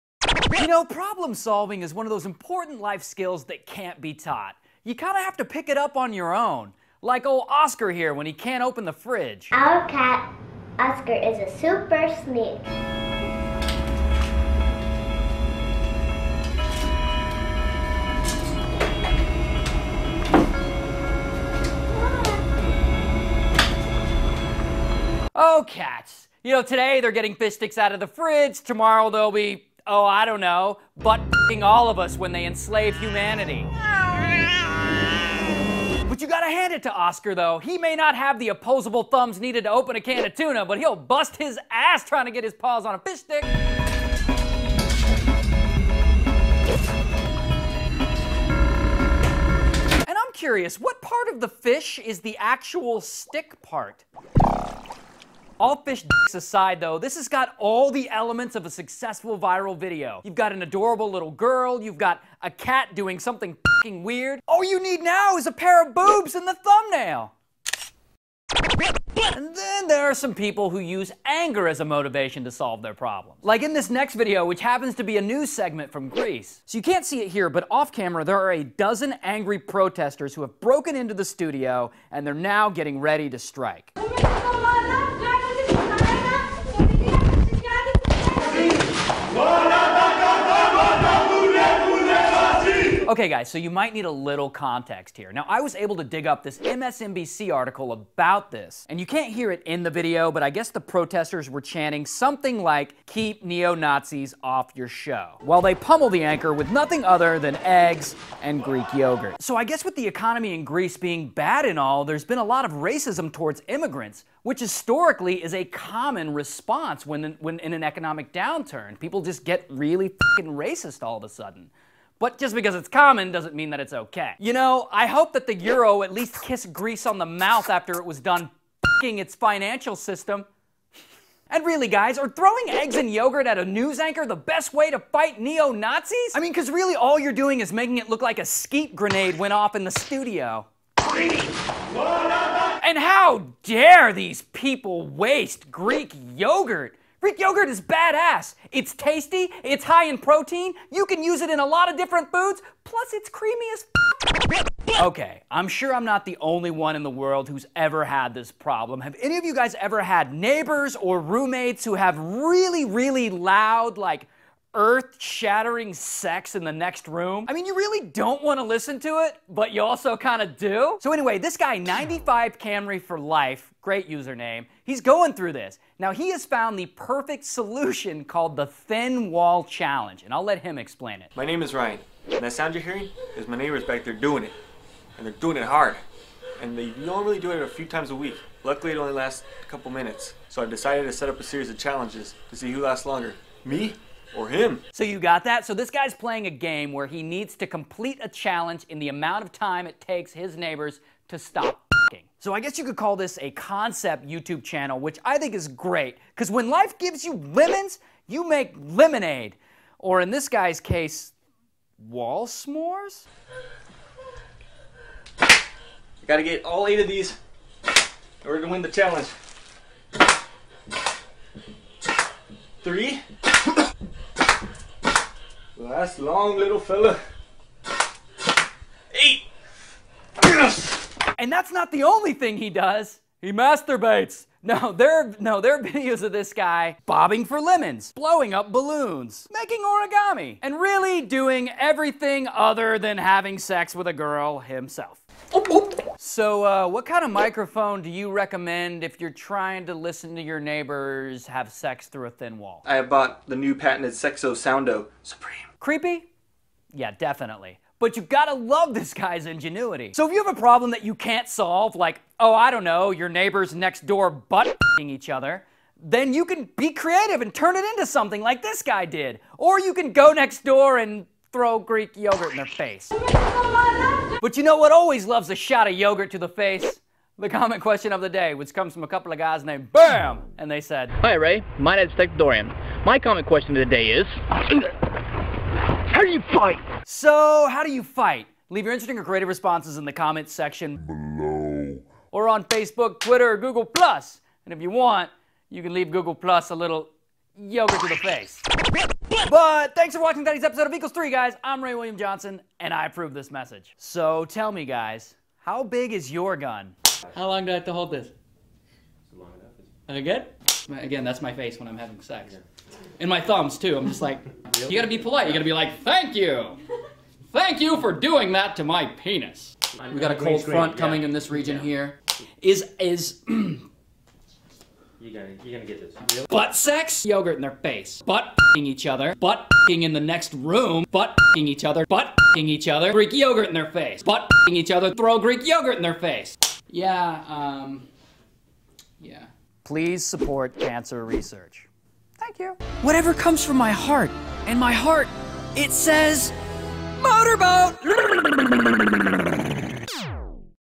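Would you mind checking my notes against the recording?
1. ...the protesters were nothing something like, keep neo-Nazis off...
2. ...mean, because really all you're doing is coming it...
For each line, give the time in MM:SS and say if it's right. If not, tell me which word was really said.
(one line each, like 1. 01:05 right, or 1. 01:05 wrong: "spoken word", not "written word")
1. 01:40 wrong: "chanting", not "nothing"
2. 02:16 wrong: "making", not "coming".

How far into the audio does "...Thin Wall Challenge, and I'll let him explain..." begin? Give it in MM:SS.
02:58.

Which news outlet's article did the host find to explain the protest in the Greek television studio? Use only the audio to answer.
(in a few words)
MSNBC.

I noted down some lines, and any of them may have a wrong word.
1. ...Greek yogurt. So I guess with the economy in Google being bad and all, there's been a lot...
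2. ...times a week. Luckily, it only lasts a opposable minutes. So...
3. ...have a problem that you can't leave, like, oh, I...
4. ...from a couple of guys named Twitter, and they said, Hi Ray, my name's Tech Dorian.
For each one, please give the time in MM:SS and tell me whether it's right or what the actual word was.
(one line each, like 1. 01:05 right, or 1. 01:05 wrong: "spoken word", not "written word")
1. 01:48 wrong: "Greece", not "Google"
2. 03:07 wrong: "couple", not "opposable"
3. 04:20 wrong: "solve", not "leave"
4. 04:38 wrong: "BAM", not "Twitter".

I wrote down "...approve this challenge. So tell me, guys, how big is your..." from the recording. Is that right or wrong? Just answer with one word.
wrong.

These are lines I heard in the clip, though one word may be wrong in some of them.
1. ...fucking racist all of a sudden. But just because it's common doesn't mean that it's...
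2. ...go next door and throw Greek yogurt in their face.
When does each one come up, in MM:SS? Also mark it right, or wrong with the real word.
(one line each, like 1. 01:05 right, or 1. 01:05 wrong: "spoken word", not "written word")
1. 02:00 right
2. 04:30 right.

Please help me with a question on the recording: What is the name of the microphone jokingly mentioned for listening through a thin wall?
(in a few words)
Sexo Soundo Supreme.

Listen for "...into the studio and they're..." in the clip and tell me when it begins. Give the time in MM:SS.
01:20.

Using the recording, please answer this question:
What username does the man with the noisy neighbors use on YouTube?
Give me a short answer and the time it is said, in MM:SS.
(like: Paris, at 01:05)
95 Camry for life, at 02:51.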